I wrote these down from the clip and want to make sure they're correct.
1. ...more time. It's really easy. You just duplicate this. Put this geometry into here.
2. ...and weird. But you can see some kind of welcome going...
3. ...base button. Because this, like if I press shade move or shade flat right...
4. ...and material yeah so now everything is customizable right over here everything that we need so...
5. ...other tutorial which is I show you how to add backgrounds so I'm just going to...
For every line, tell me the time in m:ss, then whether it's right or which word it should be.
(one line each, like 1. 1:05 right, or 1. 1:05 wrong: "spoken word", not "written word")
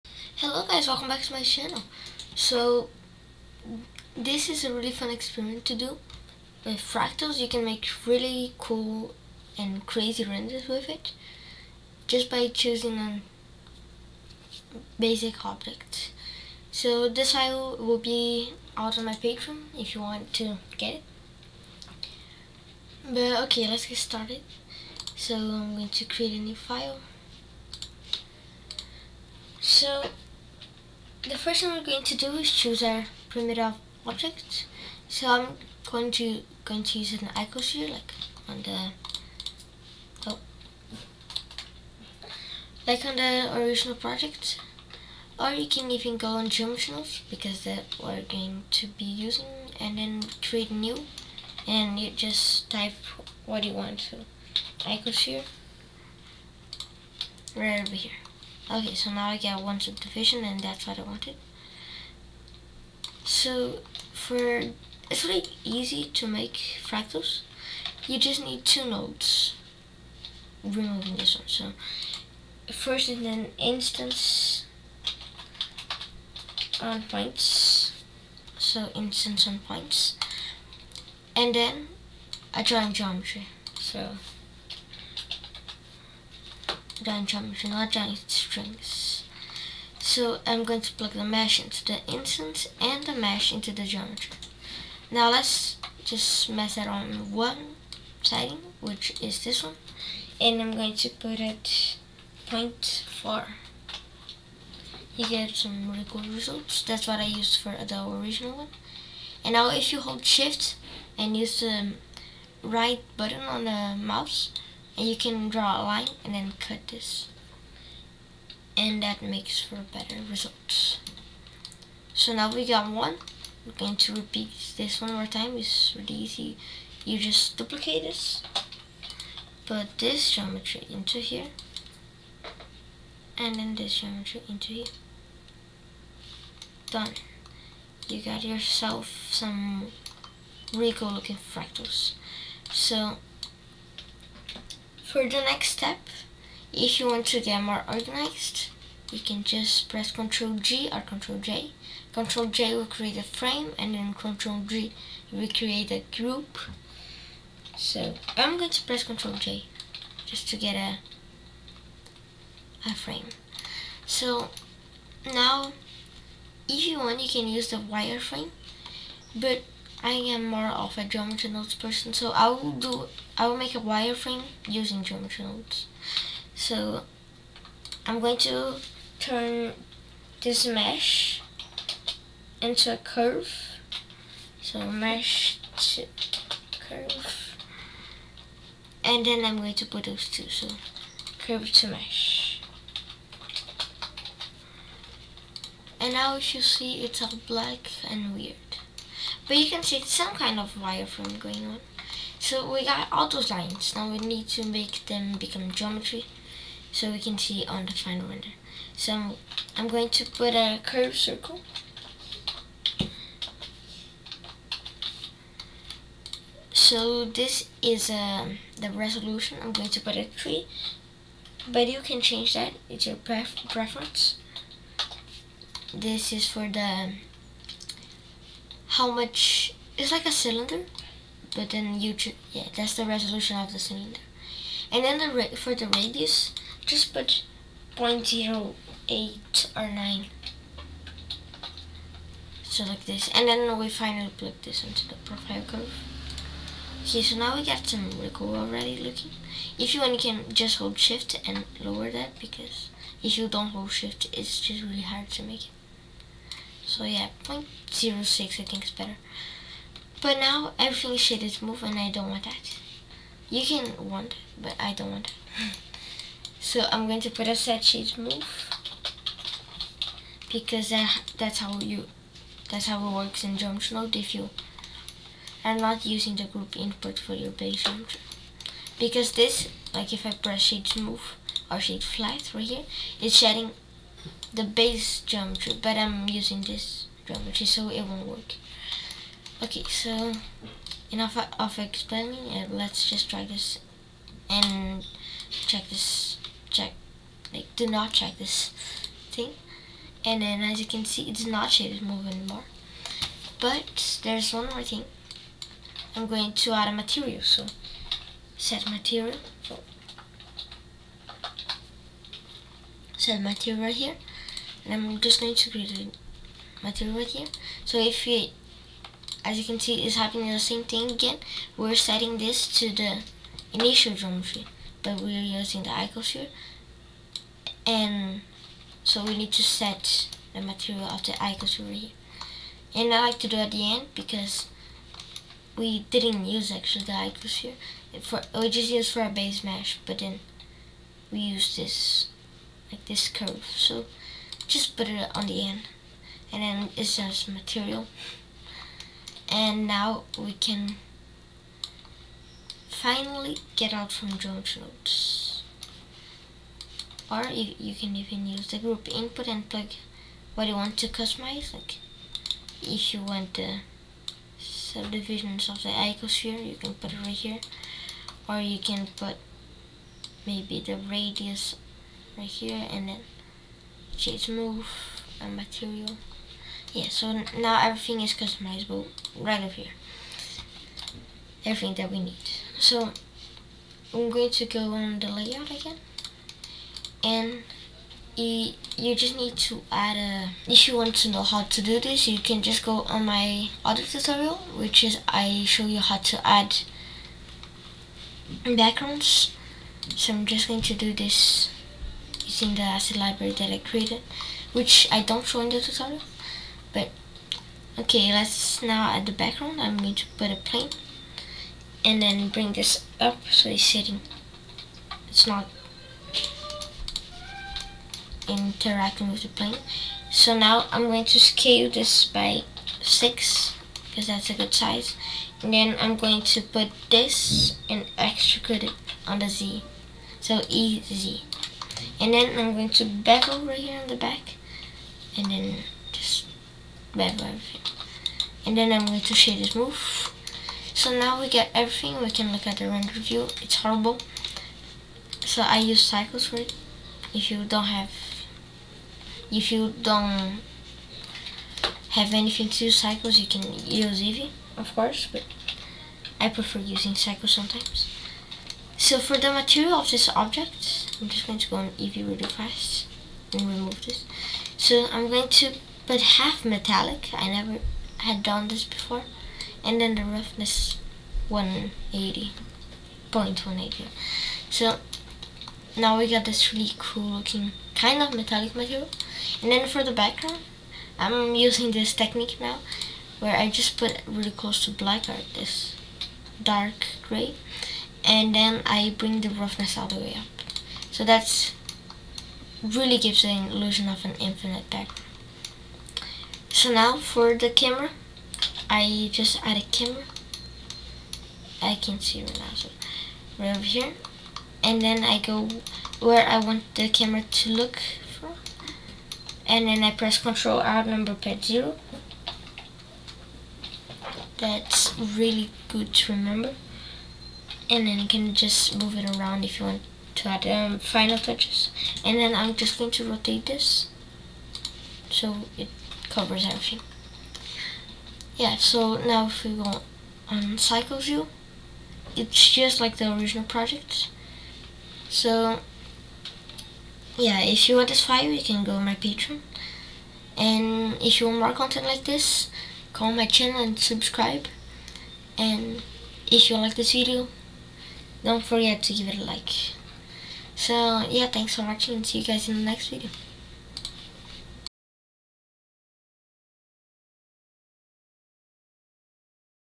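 1. 2:05 right
2. 3:18 wrong: "wireframe", not "welcome"
3. 4:37 wrong: "function", not "button"
4. 6:15 right
5. 6:33 right.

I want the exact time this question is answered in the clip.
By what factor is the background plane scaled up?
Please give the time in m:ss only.
7:03.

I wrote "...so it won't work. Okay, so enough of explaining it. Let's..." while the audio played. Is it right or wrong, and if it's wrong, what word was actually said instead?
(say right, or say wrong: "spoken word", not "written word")
right.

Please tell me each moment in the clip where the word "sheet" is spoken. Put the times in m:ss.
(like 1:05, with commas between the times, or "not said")
4:27.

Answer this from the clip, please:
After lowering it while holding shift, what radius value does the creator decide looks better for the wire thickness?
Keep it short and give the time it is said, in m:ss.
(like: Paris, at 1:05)
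0.06, at 4:17.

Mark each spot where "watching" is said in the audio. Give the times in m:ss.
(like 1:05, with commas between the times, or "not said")
9:11.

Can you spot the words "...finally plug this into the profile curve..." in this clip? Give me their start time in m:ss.
4:03.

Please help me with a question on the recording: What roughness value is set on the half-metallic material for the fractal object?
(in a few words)
0.180.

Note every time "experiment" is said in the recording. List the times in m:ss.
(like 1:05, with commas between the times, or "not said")
0:05.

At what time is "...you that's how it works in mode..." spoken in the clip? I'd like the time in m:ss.
4:31.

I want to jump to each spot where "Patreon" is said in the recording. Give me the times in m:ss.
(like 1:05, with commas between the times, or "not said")
0:19, 8:59.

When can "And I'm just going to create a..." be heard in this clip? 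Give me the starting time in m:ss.
5:14.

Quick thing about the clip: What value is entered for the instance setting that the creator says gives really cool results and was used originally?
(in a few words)
0.4.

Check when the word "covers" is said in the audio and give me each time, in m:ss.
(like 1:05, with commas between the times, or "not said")
8:46.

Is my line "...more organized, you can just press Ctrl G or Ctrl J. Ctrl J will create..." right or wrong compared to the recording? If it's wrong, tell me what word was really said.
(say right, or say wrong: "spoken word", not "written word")
right.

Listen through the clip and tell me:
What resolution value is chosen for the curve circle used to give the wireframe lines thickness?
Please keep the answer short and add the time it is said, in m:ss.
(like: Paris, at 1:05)
3, at 3:40.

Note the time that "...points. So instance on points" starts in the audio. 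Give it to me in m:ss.
1:17.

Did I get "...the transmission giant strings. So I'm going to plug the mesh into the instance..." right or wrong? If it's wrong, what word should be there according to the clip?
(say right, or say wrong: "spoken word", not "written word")
right.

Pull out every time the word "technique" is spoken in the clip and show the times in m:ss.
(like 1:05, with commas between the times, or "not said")
8:02.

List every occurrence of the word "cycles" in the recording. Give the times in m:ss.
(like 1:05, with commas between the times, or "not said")
7:26, 7:32, 7:37, 8:50.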